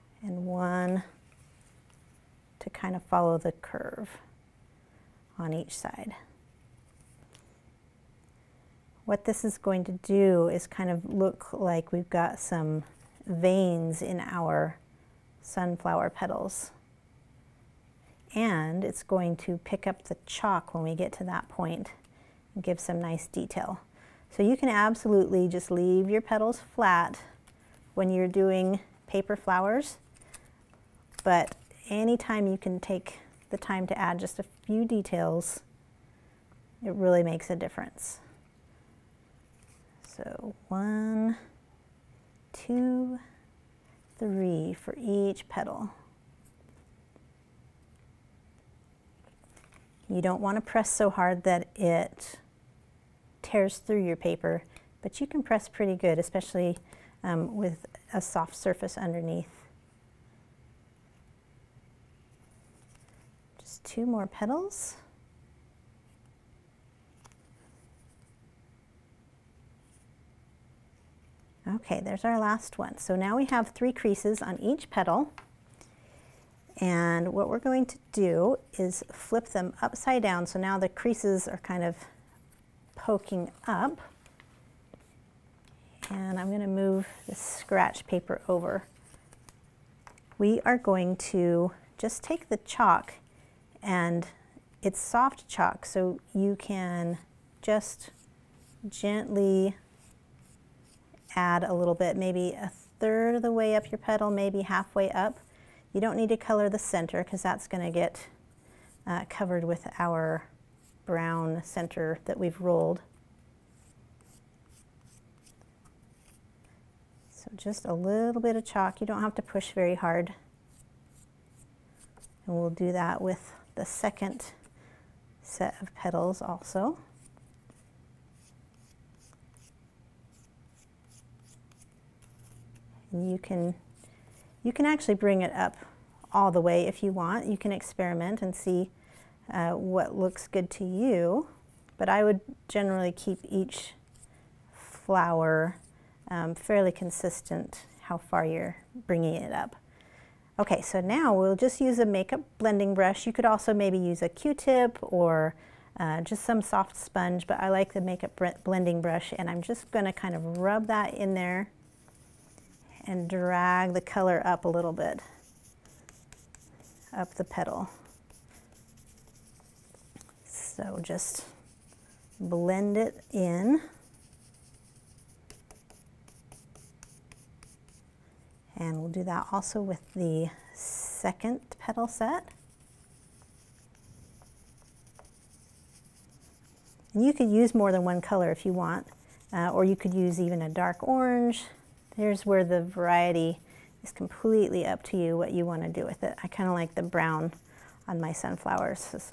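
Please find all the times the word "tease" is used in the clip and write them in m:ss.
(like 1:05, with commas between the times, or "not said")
not said.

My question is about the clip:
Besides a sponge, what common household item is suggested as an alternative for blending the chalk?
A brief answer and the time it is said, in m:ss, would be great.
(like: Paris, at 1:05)
Q-tip, at 2:34.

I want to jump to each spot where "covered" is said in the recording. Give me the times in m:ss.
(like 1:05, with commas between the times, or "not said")
1:49.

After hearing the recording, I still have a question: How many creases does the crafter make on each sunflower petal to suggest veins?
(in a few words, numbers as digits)
3.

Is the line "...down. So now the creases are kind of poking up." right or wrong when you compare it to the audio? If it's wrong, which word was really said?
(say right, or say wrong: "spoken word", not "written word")
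right.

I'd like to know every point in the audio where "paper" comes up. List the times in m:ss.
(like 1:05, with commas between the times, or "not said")
0:29, 0:54, 1:28.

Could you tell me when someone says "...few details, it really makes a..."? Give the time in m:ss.
0:34.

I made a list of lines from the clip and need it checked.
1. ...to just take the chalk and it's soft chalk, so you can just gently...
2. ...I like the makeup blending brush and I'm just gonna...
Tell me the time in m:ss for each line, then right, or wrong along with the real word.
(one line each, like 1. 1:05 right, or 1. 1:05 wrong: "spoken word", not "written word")
1. 1:31 right
2. 2:37 right.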